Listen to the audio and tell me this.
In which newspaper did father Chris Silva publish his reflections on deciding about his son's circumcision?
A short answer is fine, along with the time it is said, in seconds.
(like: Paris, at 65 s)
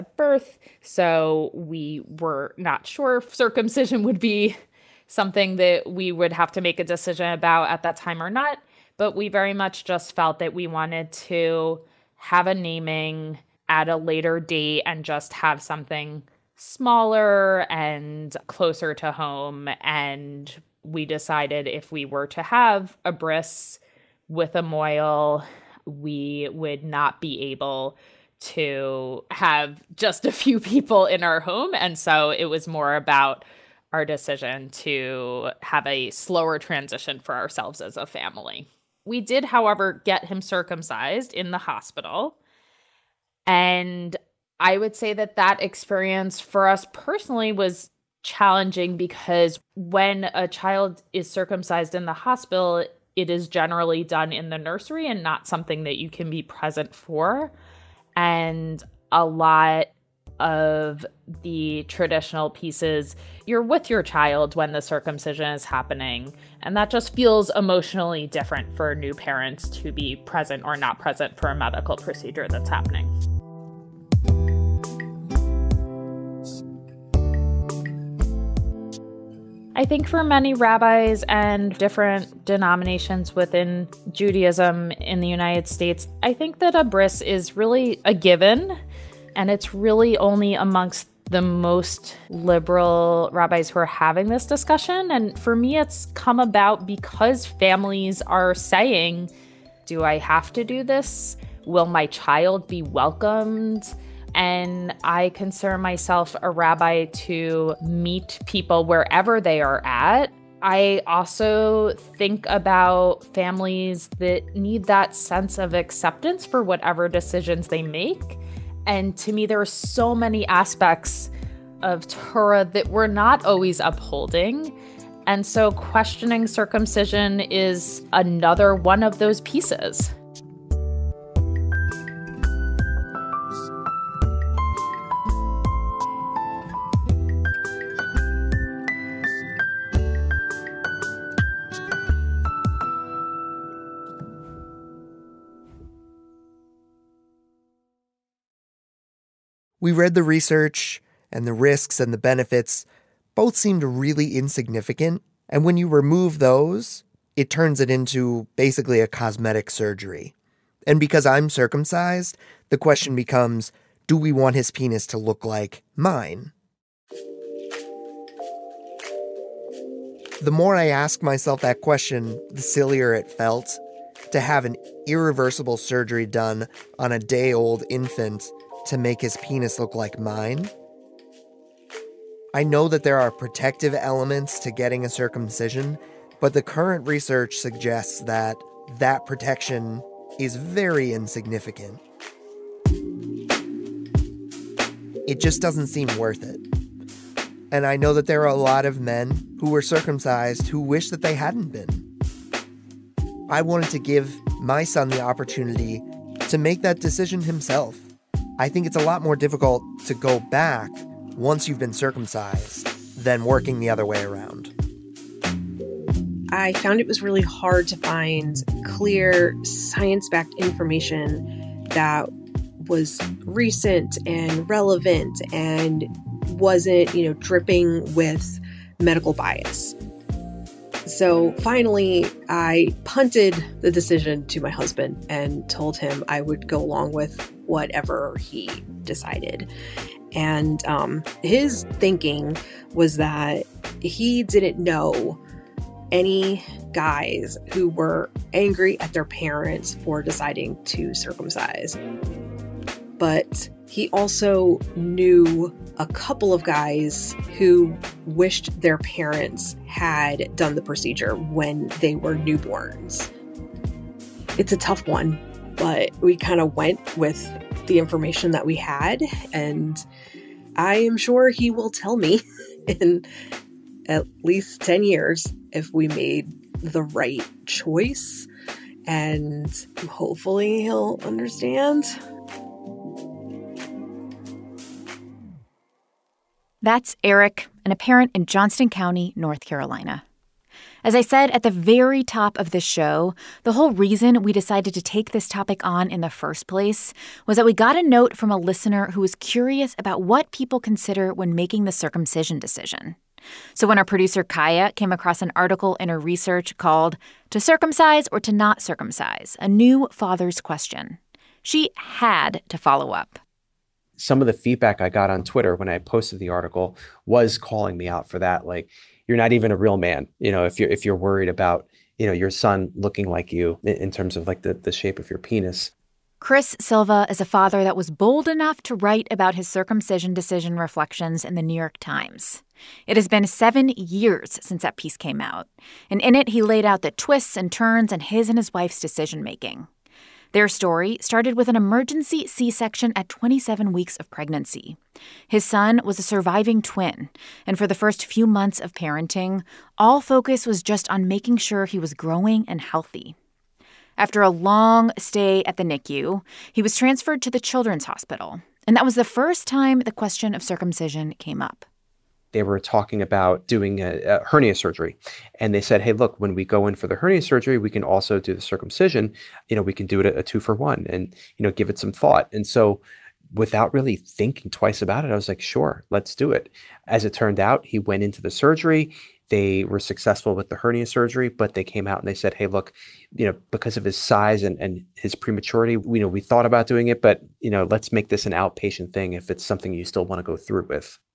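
The New York Times, at 331 s.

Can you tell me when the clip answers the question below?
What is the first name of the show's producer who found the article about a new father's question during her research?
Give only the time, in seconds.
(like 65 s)
304 s.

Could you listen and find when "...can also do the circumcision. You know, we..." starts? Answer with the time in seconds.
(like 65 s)
367 s.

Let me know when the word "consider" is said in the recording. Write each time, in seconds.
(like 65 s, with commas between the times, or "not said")
105 s, 300 s.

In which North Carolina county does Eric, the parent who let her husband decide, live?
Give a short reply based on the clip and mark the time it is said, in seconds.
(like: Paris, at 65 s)
Johnston County, at 288 s.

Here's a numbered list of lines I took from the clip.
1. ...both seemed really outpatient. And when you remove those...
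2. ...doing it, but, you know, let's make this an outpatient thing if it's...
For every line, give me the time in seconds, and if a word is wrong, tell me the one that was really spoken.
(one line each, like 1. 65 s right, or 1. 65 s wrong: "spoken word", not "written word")
1. 153 s wrong: "insignificant", not "outpatient"
2. 386 s right.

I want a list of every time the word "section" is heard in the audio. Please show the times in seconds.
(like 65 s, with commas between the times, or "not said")
342 s.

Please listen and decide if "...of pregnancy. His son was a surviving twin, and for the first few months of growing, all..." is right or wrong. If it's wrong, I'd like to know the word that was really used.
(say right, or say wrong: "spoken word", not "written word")
wrong: "parenting", not "growing".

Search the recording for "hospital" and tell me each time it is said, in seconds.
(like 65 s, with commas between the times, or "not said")
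41 s, 52 s, 358 s.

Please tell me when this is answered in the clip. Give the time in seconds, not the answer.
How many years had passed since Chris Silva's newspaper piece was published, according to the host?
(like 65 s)
333 s.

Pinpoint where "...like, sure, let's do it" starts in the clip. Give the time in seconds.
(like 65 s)
375 s.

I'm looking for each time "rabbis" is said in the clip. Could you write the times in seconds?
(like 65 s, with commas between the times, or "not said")
80 s, 93 s, 106 s.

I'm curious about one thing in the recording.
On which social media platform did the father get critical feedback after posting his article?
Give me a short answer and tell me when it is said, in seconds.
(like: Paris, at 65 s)
Twitter, at 315 s.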